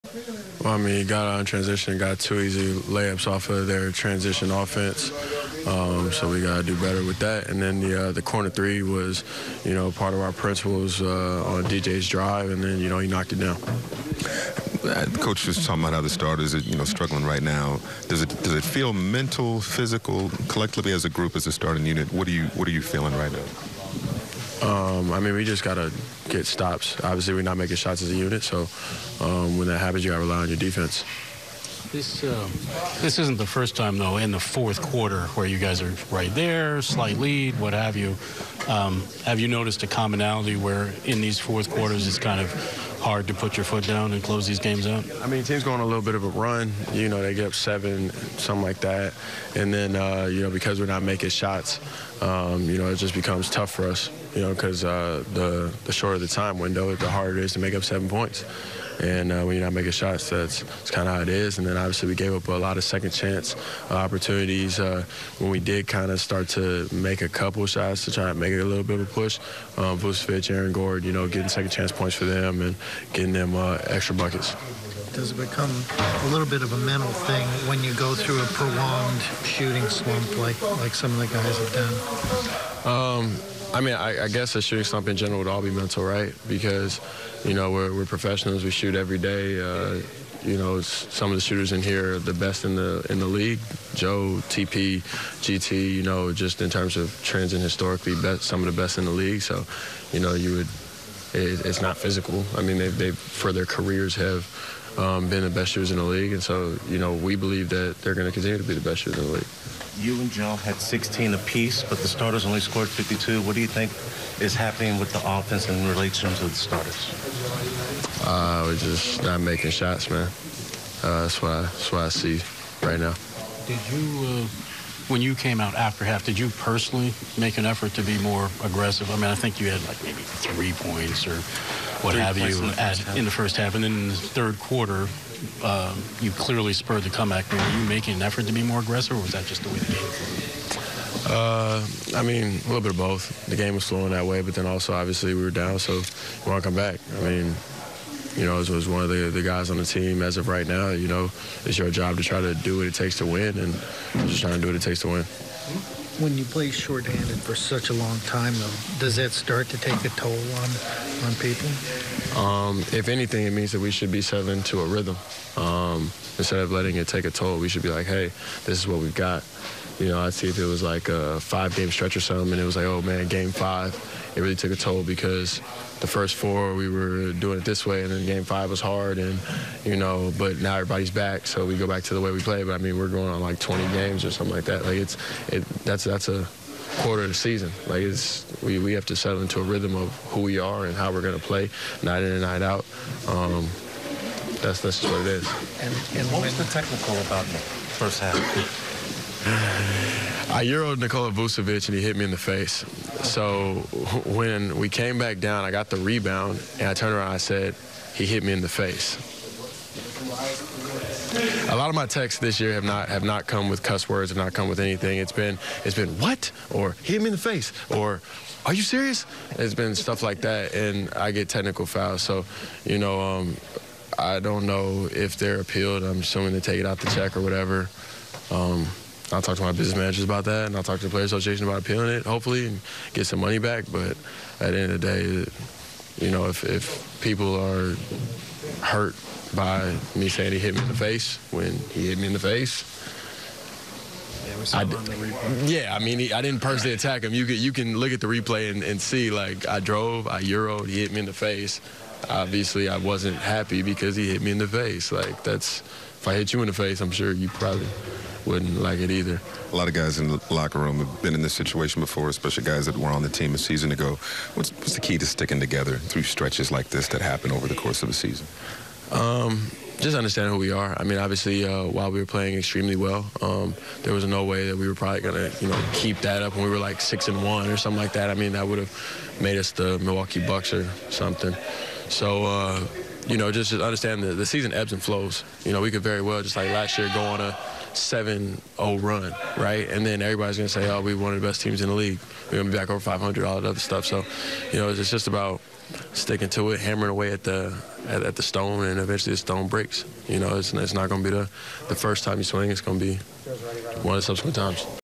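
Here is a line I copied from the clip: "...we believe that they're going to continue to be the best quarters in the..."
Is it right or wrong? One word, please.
wrong.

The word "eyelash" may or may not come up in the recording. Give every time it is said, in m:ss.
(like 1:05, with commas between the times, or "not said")
not said.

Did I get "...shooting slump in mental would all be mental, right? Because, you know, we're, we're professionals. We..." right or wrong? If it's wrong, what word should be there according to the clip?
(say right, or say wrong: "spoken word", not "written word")
wrong: "general", not "mental".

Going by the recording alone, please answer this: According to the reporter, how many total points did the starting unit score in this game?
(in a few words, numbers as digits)
52.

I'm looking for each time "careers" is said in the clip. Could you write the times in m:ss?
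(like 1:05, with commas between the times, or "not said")
1:43.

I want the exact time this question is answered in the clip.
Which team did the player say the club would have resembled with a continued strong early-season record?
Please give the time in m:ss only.
4:39.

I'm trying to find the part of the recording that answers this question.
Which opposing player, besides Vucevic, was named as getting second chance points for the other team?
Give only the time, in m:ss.
1:10.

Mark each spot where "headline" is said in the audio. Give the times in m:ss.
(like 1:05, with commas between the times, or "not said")
not said.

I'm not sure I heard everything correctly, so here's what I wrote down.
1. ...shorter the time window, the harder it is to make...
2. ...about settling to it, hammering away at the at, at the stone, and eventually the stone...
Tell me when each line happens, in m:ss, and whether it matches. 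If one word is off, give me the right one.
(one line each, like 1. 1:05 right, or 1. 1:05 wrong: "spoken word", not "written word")
1. 0:55 right
2. 4:55 wrong: "sticking", not "settling".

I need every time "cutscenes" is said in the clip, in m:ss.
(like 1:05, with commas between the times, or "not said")
not said.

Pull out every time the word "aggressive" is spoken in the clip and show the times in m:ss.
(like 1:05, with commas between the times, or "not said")
2:08, 2:18.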